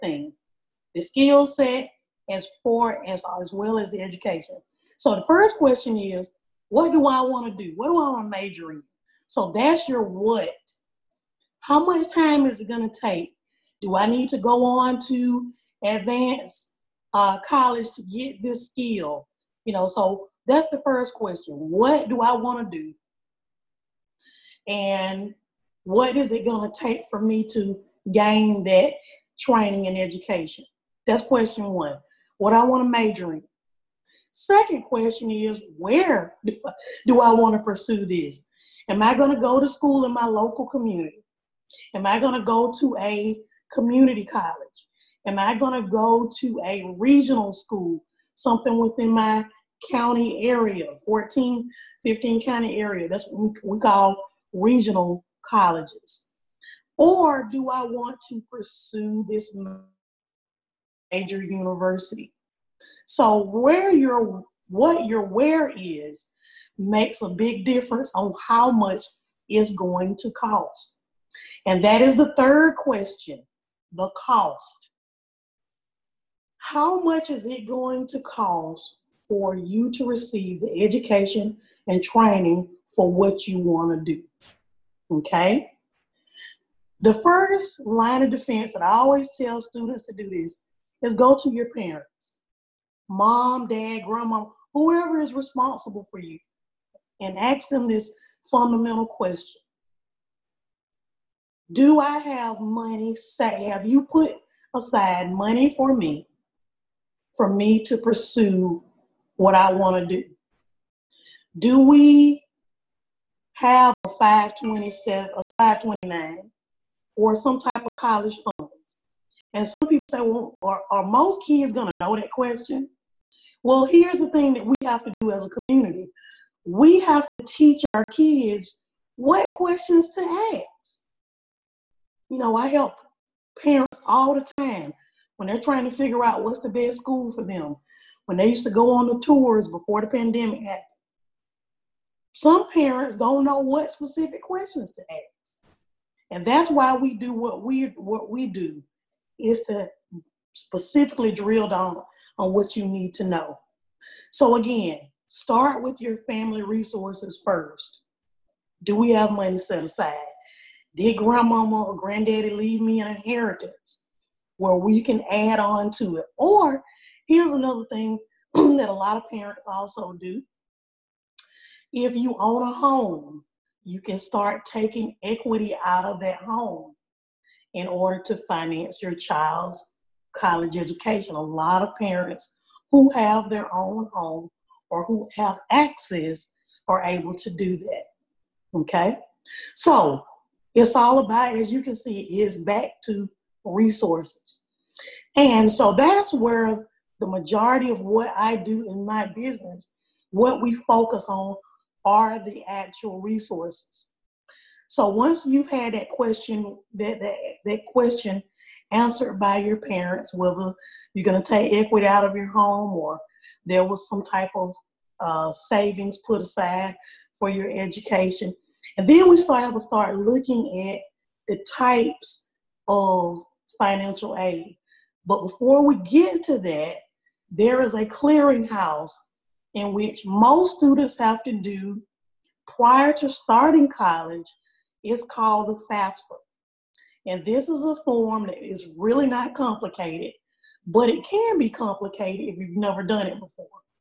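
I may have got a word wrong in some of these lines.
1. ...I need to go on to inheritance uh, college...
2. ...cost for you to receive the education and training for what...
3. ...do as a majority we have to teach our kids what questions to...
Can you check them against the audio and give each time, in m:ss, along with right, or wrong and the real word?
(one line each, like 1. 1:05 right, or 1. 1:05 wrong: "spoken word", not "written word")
1. 0:13 wrong: "advance", not "inheritance"
2. 1:18 right
3. 2:05 wrong: "community", not "majority".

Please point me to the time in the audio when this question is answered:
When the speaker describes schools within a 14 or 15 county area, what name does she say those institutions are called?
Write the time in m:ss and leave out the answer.
0:54.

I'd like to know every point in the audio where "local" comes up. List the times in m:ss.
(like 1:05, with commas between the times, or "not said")
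0:40.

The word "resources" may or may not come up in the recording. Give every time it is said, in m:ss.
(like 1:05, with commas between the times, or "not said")
2:36, 3:13, 3:23.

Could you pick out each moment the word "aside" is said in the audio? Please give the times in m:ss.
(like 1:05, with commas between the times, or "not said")
1:44, 2:39, 3:36.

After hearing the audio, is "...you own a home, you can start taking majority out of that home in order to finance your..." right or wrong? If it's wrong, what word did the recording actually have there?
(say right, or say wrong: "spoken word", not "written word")
wrong: "equity", not "majority".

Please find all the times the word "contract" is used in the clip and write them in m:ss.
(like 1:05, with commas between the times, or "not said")
not said.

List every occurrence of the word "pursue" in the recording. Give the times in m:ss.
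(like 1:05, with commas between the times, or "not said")
0:37, 0:58, 1:47.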